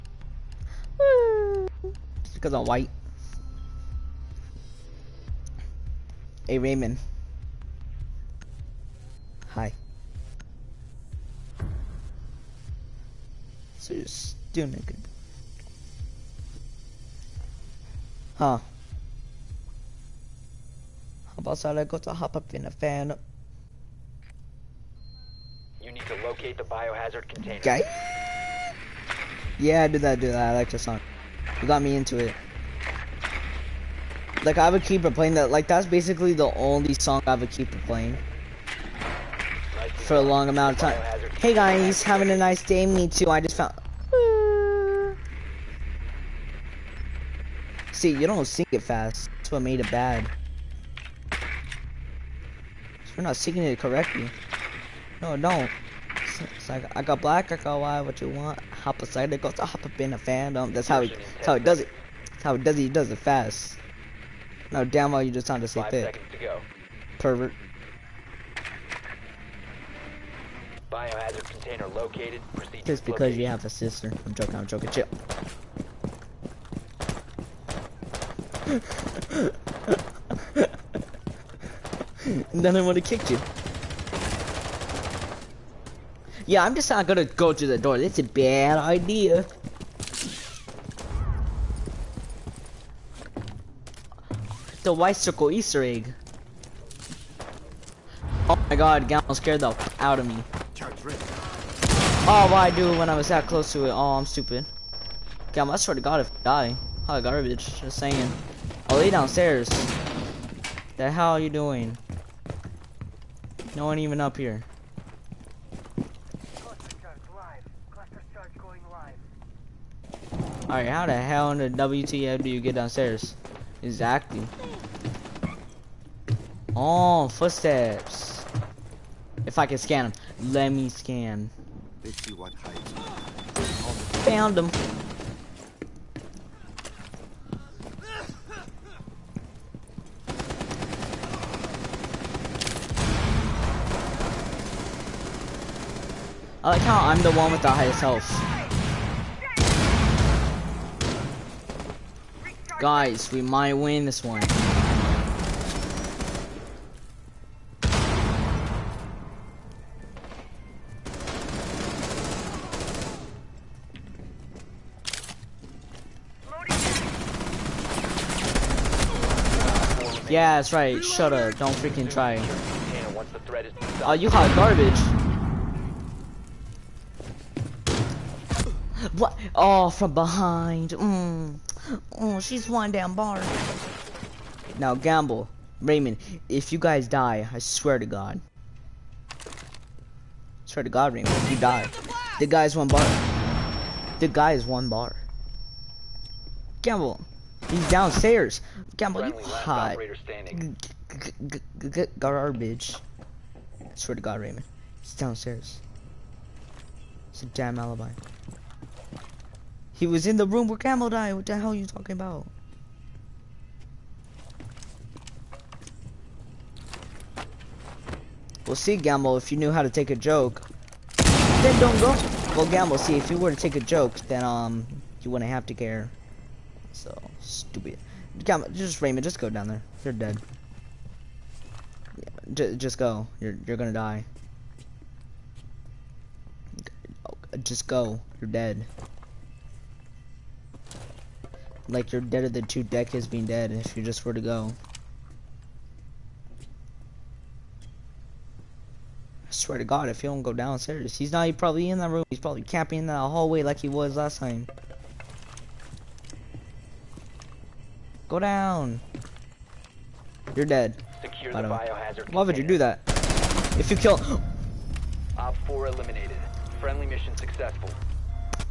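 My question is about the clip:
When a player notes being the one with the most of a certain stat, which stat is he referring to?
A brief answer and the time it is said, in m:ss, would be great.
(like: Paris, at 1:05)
health, at 2:27.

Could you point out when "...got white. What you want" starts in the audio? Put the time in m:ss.
0:57.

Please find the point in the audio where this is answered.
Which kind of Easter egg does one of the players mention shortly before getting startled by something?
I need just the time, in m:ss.
1:34.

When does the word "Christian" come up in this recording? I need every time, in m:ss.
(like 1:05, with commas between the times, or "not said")
not said.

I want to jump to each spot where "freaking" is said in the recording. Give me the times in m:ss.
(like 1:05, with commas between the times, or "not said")
2:51.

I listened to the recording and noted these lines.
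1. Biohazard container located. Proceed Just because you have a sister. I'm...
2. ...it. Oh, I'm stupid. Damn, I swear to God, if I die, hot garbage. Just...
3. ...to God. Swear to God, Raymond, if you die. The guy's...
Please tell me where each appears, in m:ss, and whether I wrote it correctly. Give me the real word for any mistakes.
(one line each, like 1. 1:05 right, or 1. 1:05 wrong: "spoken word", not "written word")
1. 1:10 right
2. 1:43 right
3. 3:07 right.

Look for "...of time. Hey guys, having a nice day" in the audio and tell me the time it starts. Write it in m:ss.
0:40.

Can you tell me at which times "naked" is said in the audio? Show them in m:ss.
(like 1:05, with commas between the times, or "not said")
0:14.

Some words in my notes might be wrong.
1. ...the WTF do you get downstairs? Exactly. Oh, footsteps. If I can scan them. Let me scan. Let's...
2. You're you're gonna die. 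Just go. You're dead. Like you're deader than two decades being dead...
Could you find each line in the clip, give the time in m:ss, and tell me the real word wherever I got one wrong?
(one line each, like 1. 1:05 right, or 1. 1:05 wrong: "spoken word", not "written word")
1. 2:01 right
2. 3:53 right.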